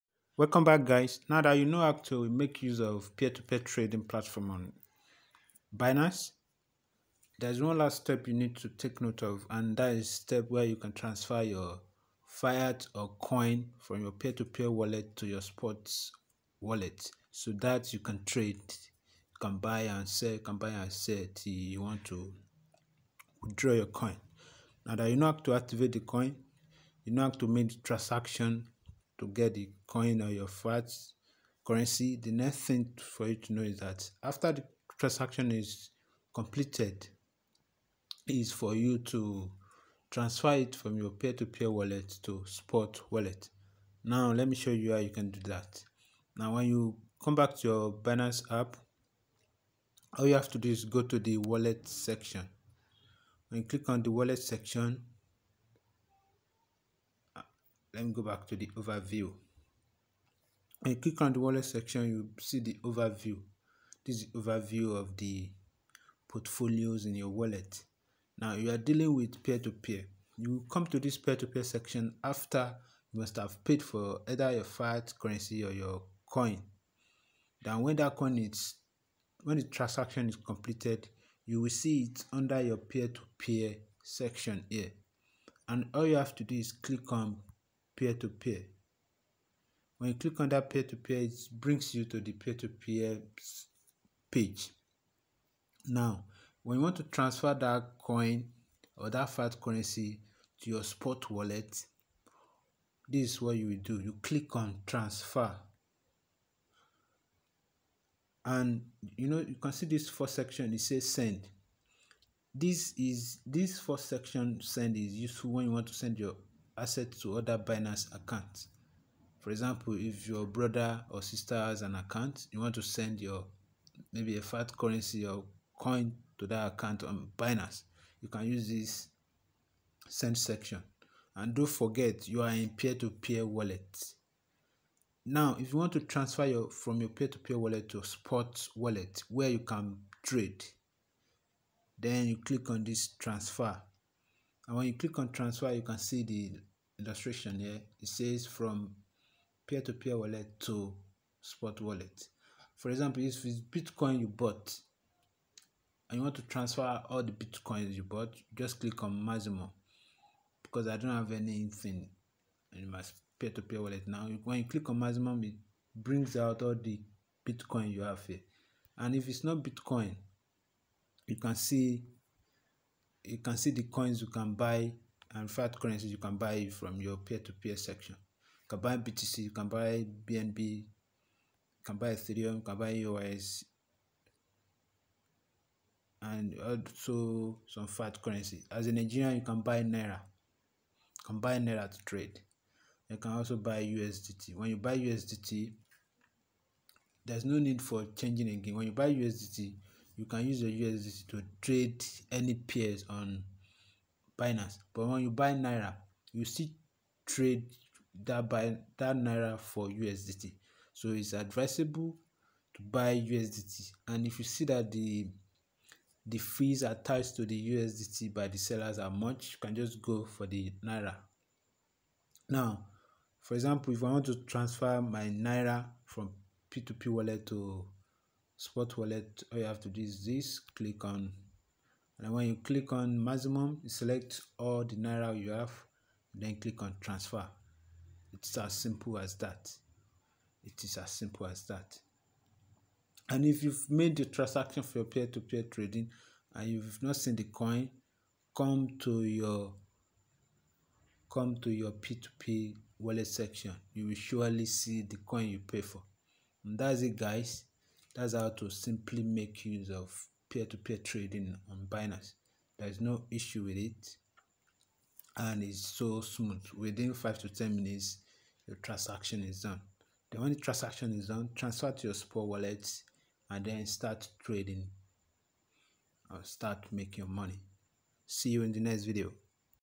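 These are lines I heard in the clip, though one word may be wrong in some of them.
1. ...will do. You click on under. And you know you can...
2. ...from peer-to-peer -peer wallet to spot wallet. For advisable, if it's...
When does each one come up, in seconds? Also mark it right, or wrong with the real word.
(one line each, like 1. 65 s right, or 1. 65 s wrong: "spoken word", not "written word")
1. 103 s wrong: "transfer", not "under"
2. 148 s wrong: "example", not "advisable".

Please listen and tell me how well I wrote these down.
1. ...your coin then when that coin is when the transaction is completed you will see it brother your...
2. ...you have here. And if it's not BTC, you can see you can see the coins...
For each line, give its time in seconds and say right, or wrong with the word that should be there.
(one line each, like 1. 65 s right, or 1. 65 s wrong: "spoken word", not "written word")
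1. 75 s wrong: "under", not "brother"
2. 167 s wrong: "Bitcoin", not "BTC".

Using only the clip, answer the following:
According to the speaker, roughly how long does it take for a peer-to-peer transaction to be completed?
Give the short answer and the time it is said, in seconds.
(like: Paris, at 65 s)
5 to 10 minutes, at 267 s.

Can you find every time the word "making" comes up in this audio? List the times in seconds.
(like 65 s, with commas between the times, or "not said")
276 s.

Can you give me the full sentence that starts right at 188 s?
As a Nigerian, you can buy Naira.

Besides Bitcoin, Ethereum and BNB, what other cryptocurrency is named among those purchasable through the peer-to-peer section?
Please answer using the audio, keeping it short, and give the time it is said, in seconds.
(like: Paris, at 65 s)
EOS, at 182 s.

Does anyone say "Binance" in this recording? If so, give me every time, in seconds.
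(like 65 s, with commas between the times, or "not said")
5 s, 48 s, 117 s, 127 s, 204 s, 261 s.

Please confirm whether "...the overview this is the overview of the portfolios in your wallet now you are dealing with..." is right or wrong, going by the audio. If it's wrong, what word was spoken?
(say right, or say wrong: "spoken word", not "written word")
right.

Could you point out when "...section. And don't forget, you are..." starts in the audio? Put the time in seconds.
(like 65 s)
130 s.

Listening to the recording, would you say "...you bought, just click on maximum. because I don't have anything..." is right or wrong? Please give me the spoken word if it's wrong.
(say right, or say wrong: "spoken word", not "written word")
right.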